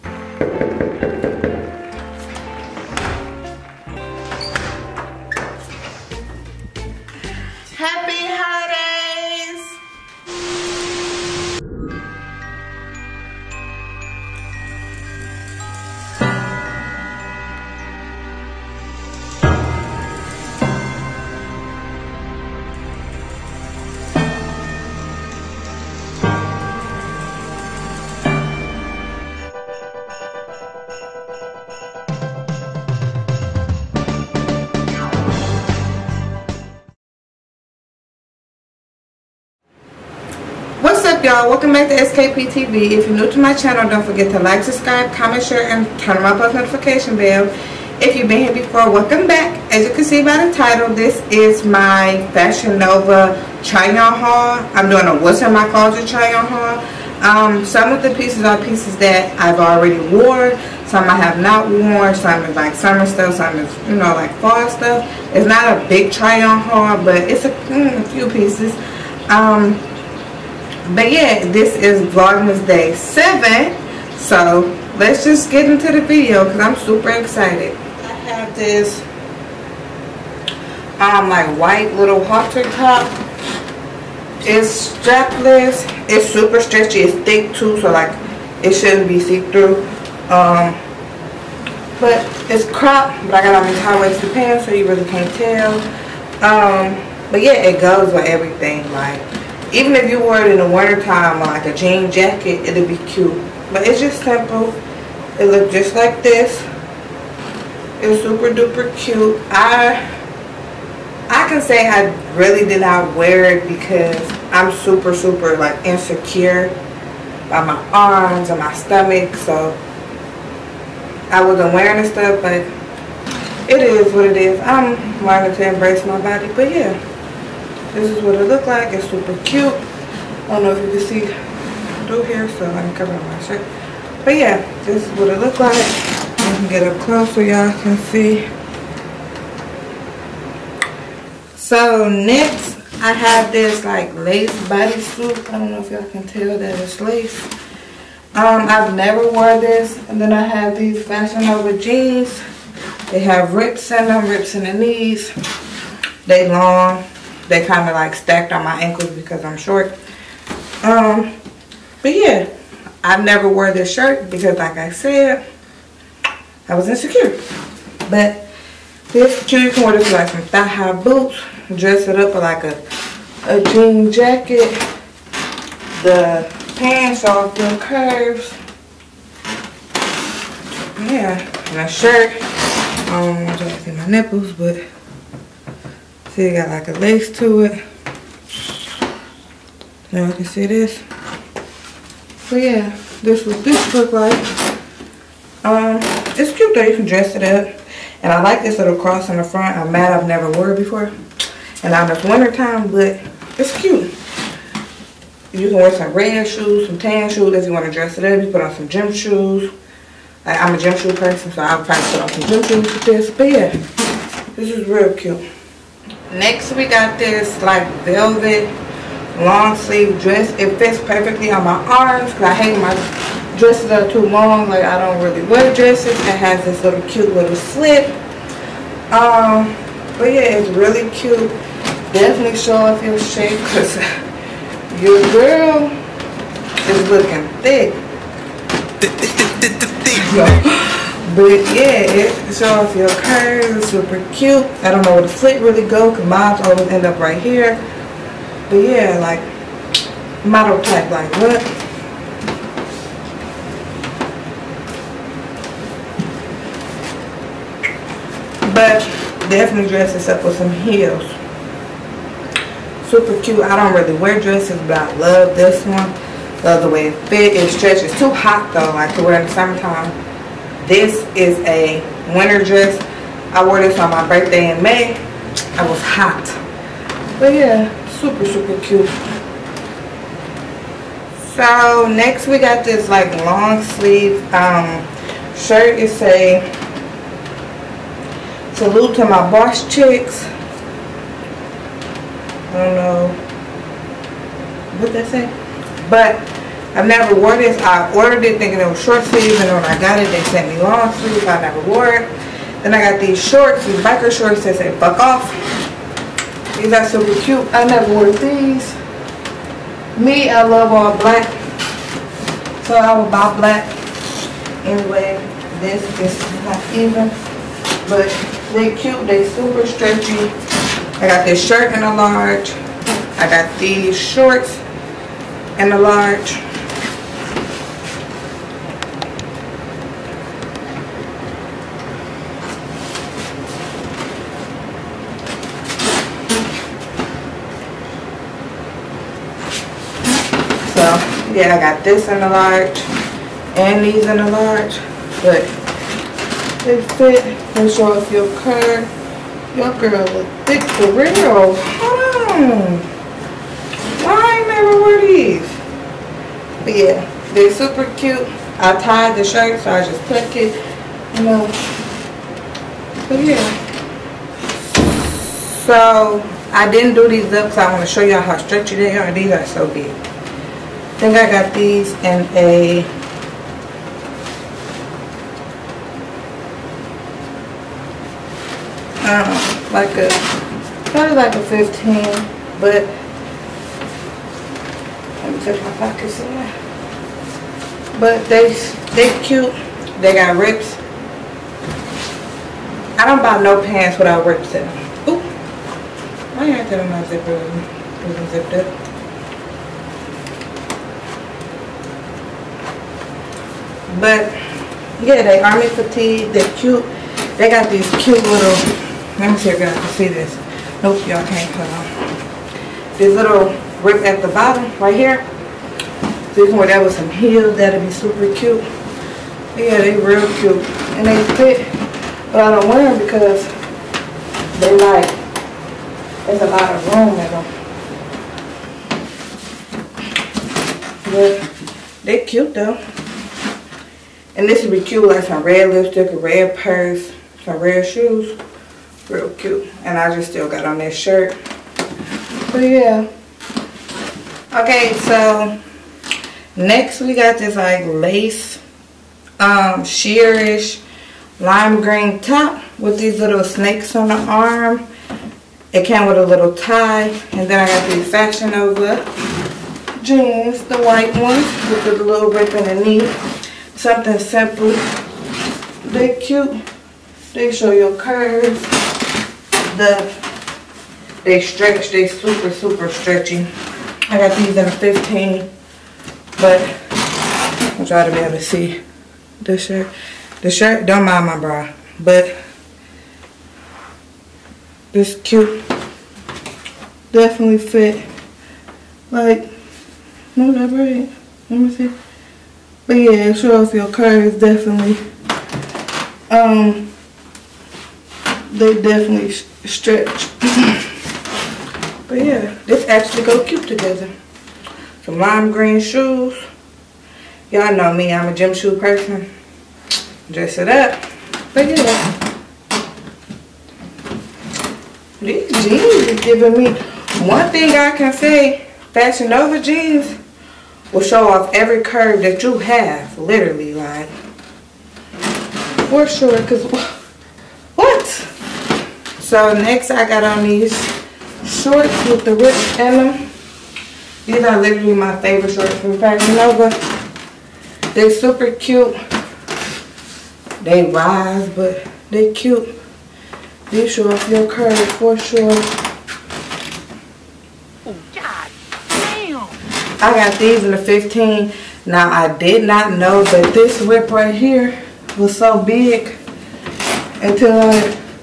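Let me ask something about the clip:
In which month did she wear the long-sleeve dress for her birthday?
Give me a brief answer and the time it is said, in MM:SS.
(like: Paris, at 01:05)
May, at 04:34.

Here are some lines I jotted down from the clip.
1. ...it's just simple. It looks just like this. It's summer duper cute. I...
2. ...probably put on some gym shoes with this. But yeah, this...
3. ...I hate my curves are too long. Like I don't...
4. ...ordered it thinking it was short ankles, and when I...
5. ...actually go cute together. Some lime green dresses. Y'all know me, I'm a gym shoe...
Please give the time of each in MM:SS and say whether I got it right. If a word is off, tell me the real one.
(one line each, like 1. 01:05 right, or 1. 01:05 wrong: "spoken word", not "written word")
1. 01:43 wrong: "super", not "summer"
2. 03:31 right
3. 03:42 wrong: "dresses", not "curves"
4. 04:58 wrong: "sleeves", not "ankles"
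5. 08:23 wrong: "shoes", not "dresses".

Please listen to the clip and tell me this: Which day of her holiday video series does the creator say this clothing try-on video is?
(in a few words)
Day 7.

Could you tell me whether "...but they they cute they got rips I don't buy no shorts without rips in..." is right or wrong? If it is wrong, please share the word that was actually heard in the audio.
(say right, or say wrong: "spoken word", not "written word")
wrong: "pants", not "shorts".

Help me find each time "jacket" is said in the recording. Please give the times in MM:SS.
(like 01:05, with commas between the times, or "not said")
01:42, 02:54.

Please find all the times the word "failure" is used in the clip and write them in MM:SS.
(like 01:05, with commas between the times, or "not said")
not said.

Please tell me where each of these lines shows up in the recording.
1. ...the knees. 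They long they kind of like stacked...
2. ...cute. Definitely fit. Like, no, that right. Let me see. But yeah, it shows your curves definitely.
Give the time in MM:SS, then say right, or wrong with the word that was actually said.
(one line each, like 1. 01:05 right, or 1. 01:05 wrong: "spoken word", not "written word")
1. 02:34 right
2. 08:05 right.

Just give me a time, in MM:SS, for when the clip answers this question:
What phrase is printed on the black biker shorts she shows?
05:05.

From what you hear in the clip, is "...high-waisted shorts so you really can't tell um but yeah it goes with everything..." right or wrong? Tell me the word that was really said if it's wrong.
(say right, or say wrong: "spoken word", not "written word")
wrong: "pants", not "shorts".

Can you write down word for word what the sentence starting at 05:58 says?
I tied the shirt, so I just tucked it.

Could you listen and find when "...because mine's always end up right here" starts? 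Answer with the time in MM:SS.
04:06.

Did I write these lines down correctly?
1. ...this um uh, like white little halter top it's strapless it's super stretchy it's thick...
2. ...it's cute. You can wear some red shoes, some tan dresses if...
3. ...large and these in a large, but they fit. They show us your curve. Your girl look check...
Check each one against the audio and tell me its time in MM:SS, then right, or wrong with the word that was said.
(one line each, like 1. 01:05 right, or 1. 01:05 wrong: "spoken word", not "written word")
1. 01:18 right
2. 03:23 wrong: "shoes", not "dresses"
3. 05:42 wrong: "thick", not "check".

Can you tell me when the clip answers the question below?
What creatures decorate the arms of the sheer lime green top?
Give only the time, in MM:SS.
07:33.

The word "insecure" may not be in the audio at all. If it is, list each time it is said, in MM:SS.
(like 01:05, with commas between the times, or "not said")
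01:55, 02:46.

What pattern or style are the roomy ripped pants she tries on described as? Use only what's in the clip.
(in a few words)
Army fatigue.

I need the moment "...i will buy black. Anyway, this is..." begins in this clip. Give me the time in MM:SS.
05:12.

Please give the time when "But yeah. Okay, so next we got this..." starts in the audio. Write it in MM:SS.
07:22.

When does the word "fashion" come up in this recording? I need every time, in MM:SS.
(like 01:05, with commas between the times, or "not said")
00:52, 02:31, 07:38, 08:39, 08:56.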